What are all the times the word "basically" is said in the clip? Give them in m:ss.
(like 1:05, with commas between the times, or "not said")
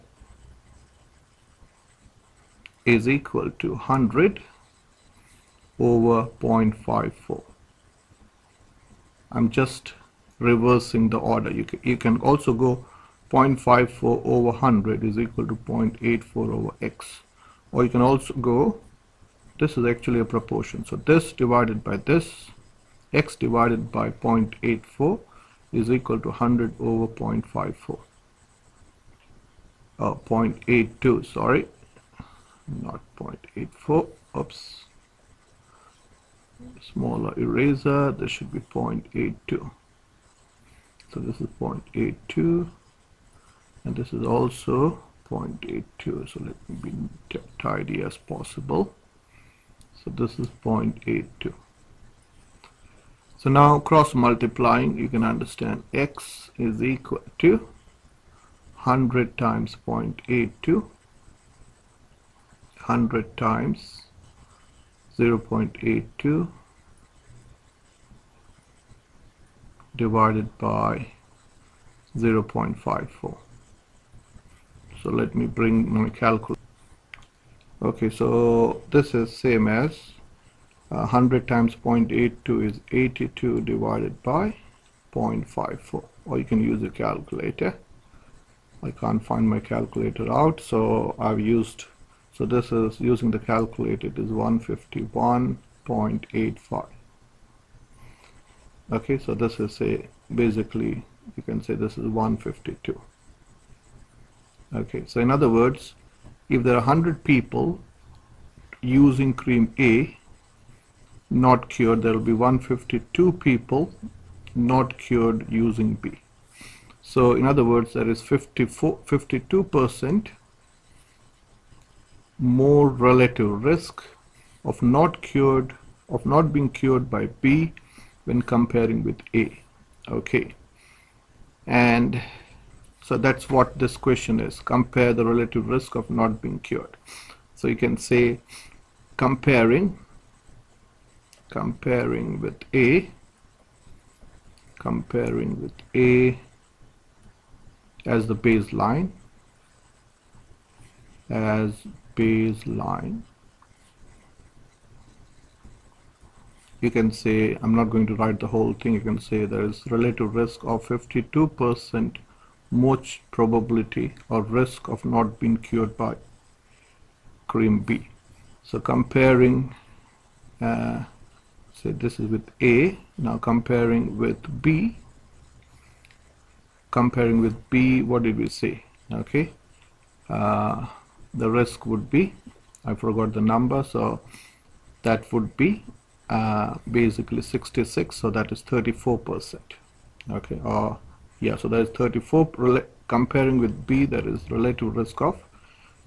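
1:40, 3:06.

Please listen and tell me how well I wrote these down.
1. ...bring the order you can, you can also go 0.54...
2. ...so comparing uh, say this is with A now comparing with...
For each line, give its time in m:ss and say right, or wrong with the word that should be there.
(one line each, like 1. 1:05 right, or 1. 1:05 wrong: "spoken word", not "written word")
1. 0:10 wrong: "reversing", not "bring"
2. 2:48 right.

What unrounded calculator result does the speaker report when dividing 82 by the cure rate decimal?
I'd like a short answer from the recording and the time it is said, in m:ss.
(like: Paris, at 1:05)
151.85, at 1:34.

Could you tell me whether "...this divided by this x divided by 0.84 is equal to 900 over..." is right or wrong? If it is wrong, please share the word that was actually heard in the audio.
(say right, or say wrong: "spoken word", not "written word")
wrong: "100", not "900".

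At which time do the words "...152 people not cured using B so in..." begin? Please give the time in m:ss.
1:52.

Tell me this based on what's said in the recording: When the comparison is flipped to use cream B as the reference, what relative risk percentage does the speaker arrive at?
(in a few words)
34%.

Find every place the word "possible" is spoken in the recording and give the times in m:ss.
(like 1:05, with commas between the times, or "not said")
0:48.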